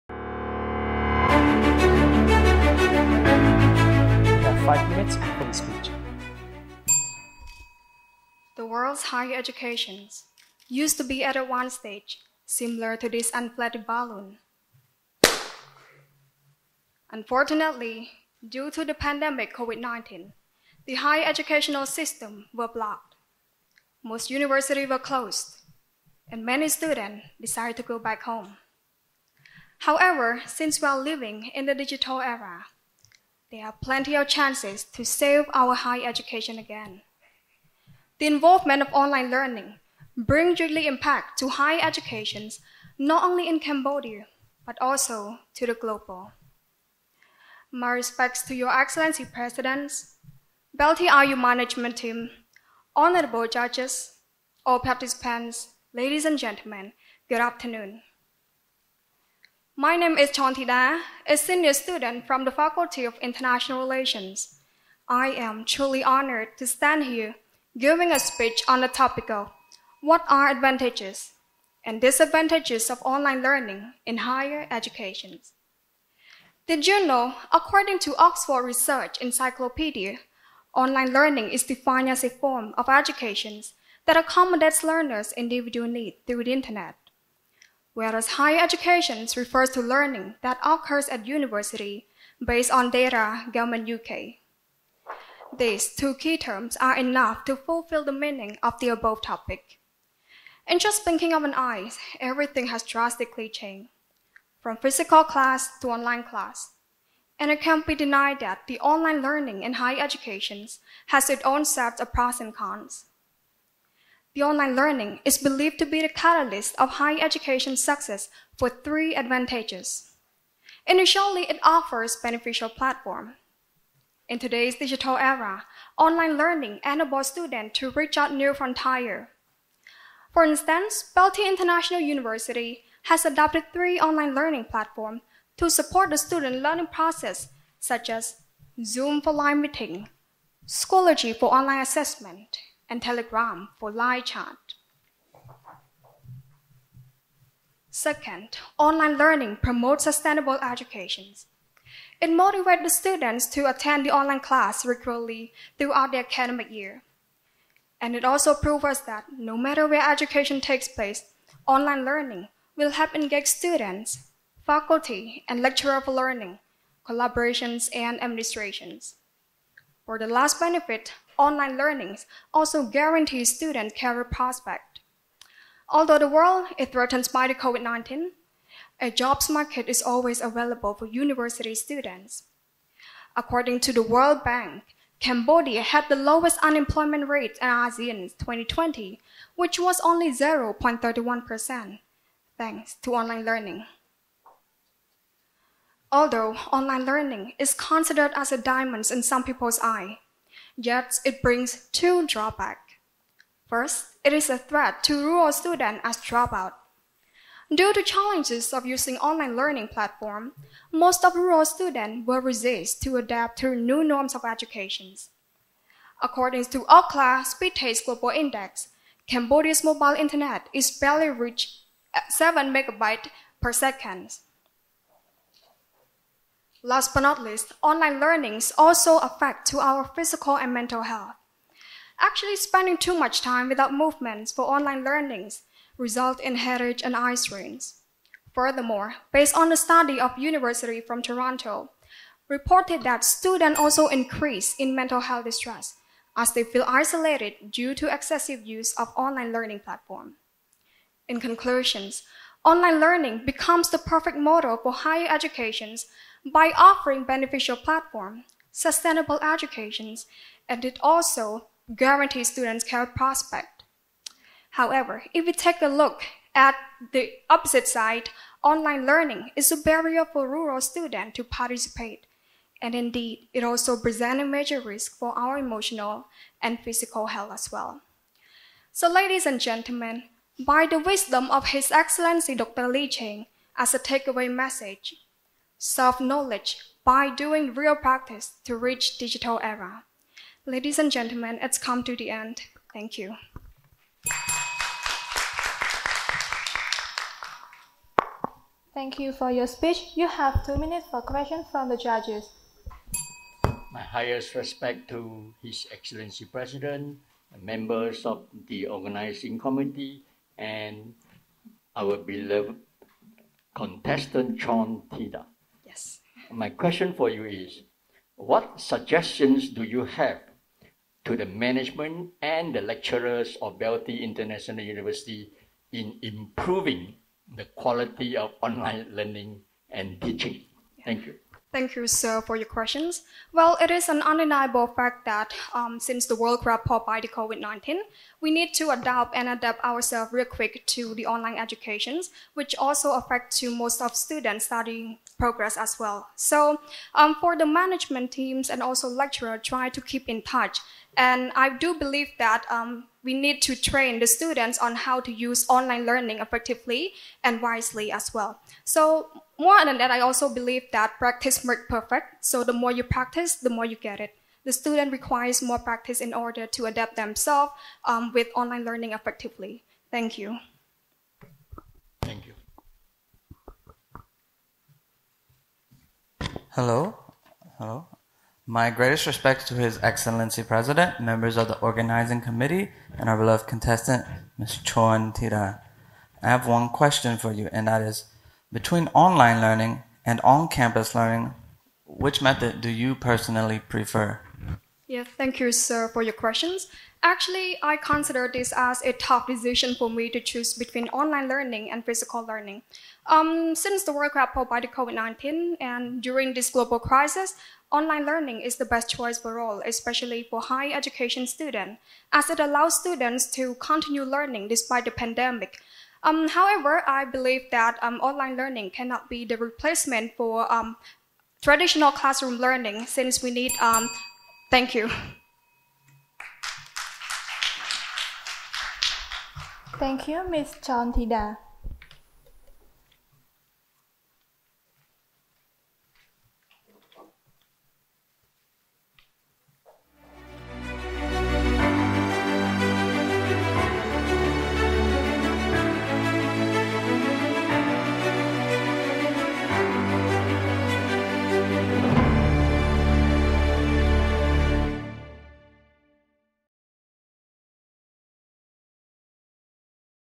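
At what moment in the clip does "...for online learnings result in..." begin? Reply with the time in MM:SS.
03:54.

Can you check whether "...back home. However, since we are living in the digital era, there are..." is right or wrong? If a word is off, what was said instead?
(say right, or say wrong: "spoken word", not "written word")
right.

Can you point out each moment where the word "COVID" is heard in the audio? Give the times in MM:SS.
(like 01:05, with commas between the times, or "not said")
00:19, 02:57, 05:37, 06:44.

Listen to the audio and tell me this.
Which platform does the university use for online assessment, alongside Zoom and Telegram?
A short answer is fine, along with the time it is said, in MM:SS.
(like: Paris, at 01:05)
Schoology, at 02:20.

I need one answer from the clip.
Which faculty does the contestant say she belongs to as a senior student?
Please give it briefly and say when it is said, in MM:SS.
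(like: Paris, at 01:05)
Faculty of International Relations, at 01:02.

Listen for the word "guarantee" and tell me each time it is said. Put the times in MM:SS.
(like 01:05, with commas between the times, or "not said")
02:52, 04:21.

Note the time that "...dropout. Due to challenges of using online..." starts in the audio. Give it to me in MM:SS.
03:26.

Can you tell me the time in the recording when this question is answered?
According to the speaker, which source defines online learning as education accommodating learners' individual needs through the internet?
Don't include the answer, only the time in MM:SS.
01:18.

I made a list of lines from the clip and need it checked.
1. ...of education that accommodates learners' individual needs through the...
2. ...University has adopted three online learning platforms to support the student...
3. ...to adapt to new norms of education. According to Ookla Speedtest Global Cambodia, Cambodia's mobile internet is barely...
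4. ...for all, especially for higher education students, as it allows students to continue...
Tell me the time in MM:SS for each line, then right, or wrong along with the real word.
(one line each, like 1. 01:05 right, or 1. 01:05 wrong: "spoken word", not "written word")
1. 01:22 right
2. 02:11 right
3. 03:33 wrong: "Index", not "Cambodia"
4. 06:49 right.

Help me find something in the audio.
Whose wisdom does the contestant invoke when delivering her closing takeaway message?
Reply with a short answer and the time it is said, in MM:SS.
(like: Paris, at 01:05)
Dr. Ly Chheng, at 04:42.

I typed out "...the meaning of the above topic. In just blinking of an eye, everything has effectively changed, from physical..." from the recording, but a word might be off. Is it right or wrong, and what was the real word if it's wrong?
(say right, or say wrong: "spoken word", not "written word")
wrong: "drastically", not "effectively".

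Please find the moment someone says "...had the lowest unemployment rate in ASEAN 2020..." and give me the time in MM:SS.
03:05.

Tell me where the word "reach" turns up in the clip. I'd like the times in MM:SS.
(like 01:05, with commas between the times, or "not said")
02:07, 03:41, 04:48.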